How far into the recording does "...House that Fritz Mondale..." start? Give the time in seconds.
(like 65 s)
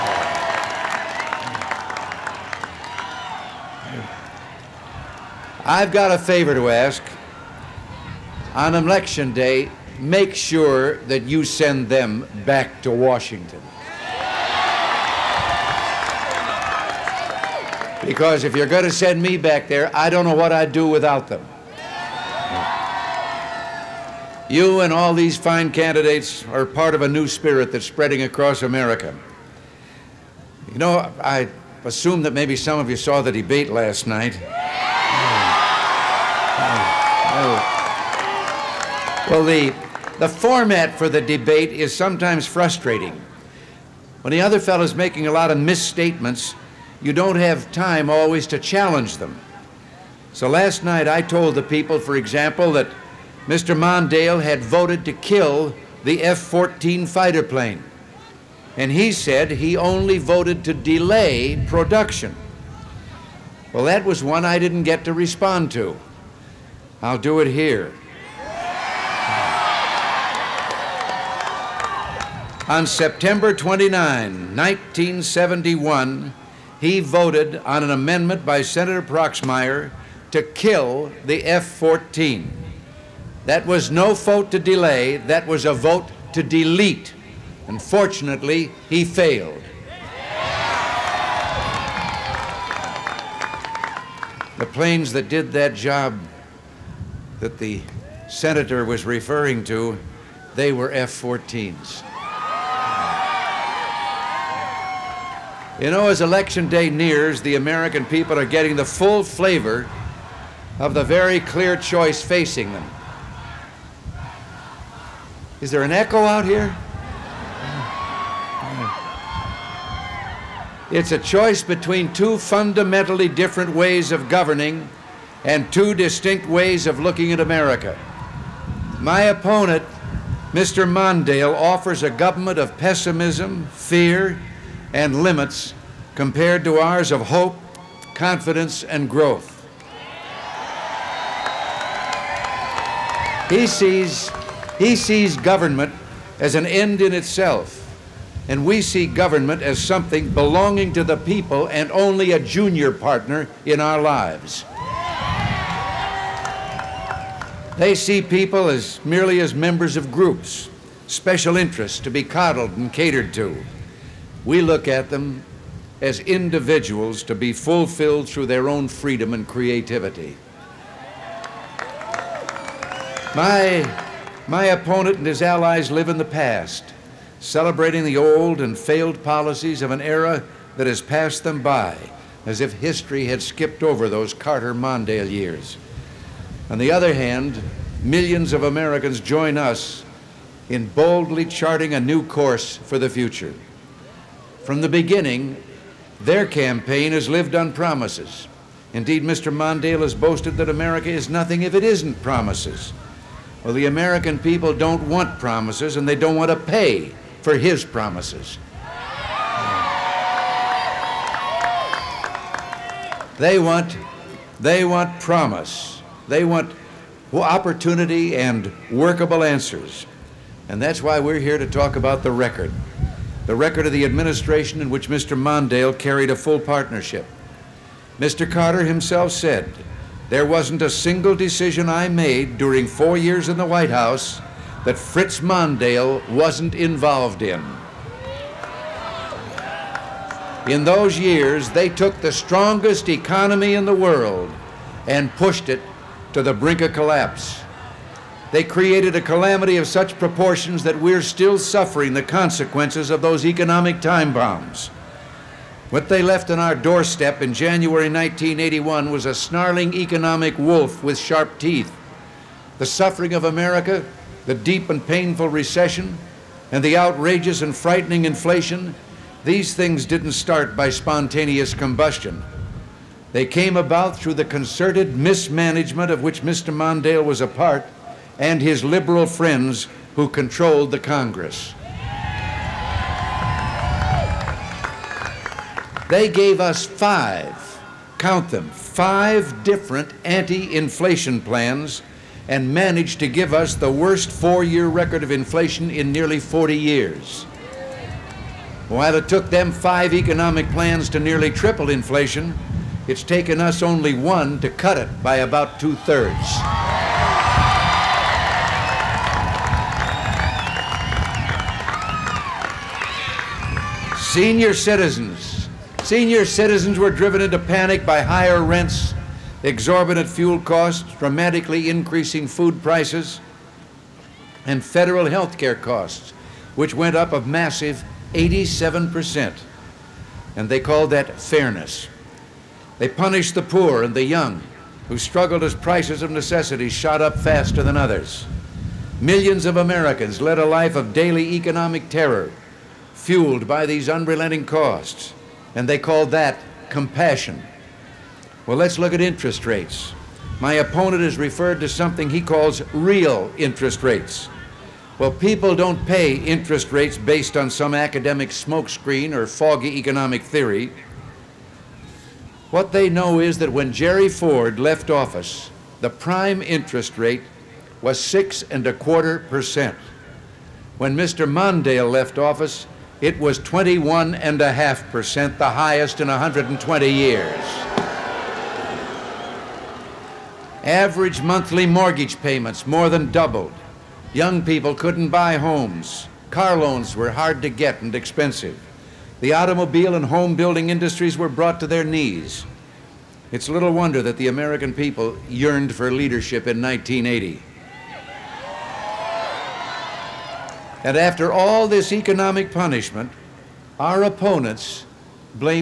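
233 s.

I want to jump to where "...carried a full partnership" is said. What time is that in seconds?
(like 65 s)
225 s.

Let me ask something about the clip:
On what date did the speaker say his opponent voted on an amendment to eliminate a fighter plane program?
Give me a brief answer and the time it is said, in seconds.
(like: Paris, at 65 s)
September 29, 1971, at 72 s.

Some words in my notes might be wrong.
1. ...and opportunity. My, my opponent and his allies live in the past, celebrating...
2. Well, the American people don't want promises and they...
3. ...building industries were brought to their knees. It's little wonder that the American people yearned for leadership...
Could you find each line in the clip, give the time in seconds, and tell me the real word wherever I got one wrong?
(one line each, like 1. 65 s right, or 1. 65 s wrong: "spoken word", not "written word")
1. 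169 s wrong: "creativity", not "opportunity"
2. 203 s right
3. 390 s right.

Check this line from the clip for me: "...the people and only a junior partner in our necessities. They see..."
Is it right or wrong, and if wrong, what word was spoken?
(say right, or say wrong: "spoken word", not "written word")
wrong: "lives", not "necessities".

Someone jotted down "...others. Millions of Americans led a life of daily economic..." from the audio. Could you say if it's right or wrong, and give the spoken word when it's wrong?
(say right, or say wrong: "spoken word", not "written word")
right.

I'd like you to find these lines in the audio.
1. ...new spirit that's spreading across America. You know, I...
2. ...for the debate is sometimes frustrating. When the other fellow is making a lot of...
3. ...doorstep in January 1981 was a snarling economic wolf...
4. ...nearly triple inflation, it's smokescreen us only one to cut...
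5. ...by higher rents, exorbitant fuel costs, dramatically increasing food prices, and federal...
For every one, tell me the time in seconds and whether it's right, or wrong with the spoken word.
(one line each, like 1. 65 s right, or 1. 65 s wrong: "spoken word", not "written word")
1. 27 s right
2. 40 s right
3. 256 s right
4. 301 s wrong: "taken", not "smokescreen"
5. 318 s right.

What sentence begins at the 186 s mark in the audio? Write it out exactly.
On the other hand, millions of Americans join us in boldly charting a new course for the future.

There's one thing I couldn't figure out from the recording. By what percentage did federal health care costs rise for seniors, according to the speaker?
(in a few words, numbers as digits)
87%.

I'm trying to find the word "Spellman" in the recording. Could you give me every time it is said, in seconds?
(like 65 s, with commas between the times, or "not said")
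not said.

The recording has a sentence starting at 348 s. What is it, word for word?
Well, let's look at interest rates.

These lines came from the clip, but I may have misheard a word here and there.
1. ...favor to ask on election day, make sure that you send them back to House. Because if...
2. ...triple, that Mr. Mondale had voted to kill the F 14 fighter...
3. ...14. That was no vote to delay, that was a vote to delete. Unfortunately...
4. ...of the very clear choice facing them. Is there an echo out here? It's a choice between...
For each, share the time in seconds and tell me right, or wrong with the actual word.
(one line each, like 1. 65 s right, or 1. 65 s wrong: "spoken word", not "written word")
1. 6 s wrong: "Washington", not "House"
2. 52 s wrong: "example", not "triple"
3. 81 s right
4. 110 s right.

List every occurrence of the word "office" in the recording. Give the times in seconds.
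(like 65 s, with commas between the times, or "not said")
365 s, 372 s.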